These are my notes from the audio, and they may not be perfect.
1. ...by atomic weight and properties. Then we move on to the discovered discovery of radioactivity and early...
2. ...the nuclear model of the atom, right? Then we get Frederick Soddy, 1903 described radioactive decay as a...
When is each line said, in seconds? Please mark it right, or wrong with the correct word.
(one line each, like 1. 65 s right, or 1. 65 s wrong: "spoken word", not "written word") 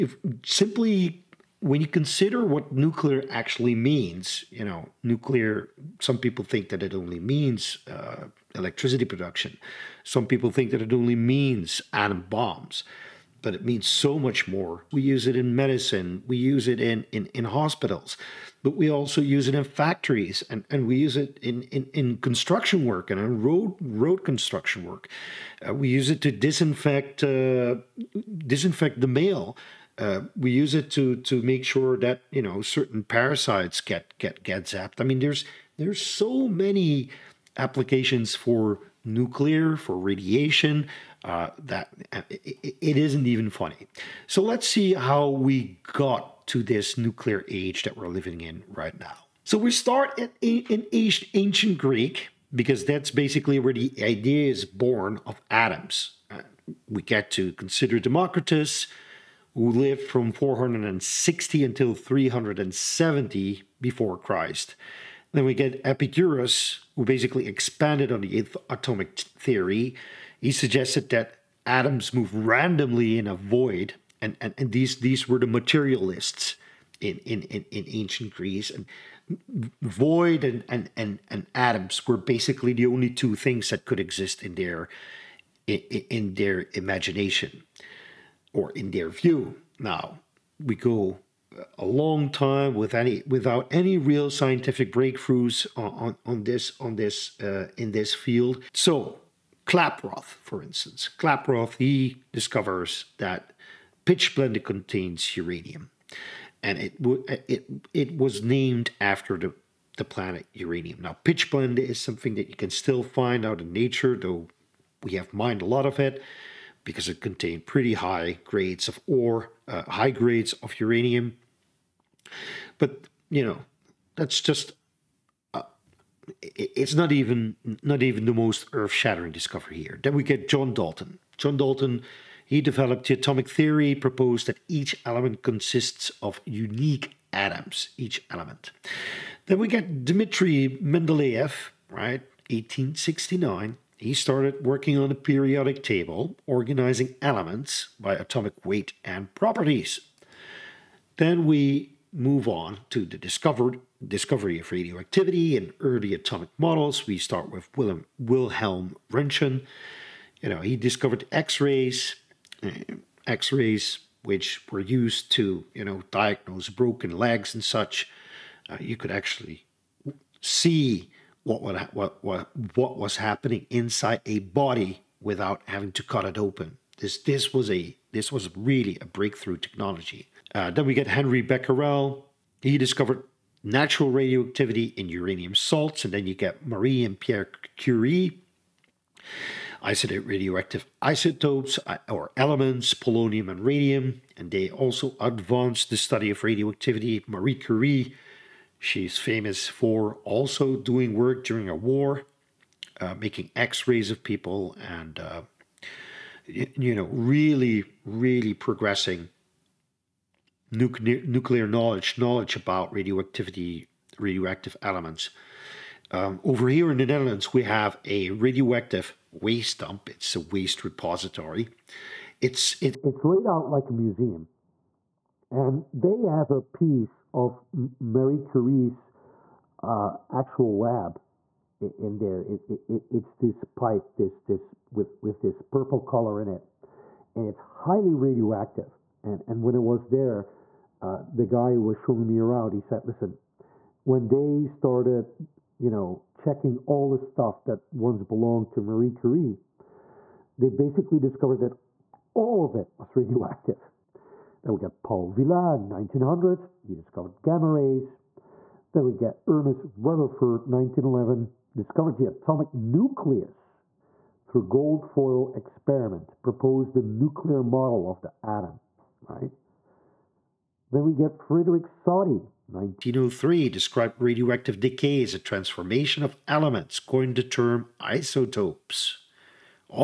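1. 147 s right
2. 266 s right.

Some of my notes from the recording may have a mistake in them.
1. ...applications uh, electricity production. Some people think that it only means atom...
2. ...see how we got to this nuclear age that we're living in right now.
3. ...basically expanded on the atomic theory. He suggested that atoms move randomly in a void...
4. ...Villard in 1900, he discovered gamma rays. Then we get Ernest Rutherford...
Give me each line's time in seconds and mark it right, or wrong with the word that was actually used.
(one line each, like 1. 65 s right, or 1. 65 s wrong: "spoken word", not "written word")
1. 7 s wrong: "means", not "applications"
2. 44 s right
3. 67 s right
4. 255 s right.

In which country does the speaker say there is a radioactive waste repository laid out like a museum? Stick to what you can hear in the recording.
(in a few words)
the Netherlands.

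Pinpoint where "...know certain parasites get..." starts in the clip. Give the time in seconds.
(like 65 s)
32 s.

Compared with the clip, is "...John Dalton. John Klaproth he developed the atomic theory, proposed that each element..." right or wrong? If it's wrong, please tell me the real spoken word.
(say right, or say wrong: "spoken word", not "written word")
wrong: "Dalton", not "Klaproth".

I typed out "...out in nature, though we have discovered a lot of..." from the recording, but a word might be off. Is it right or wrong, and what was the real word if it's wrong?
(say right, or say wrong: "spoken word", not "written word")
wrong: "mined", not "discovered".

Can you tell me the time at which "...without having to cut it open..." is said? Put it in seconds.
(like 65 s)
175 s.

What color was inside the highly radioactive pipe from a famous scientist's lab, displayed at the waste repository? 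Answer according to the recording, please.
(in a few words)
purple.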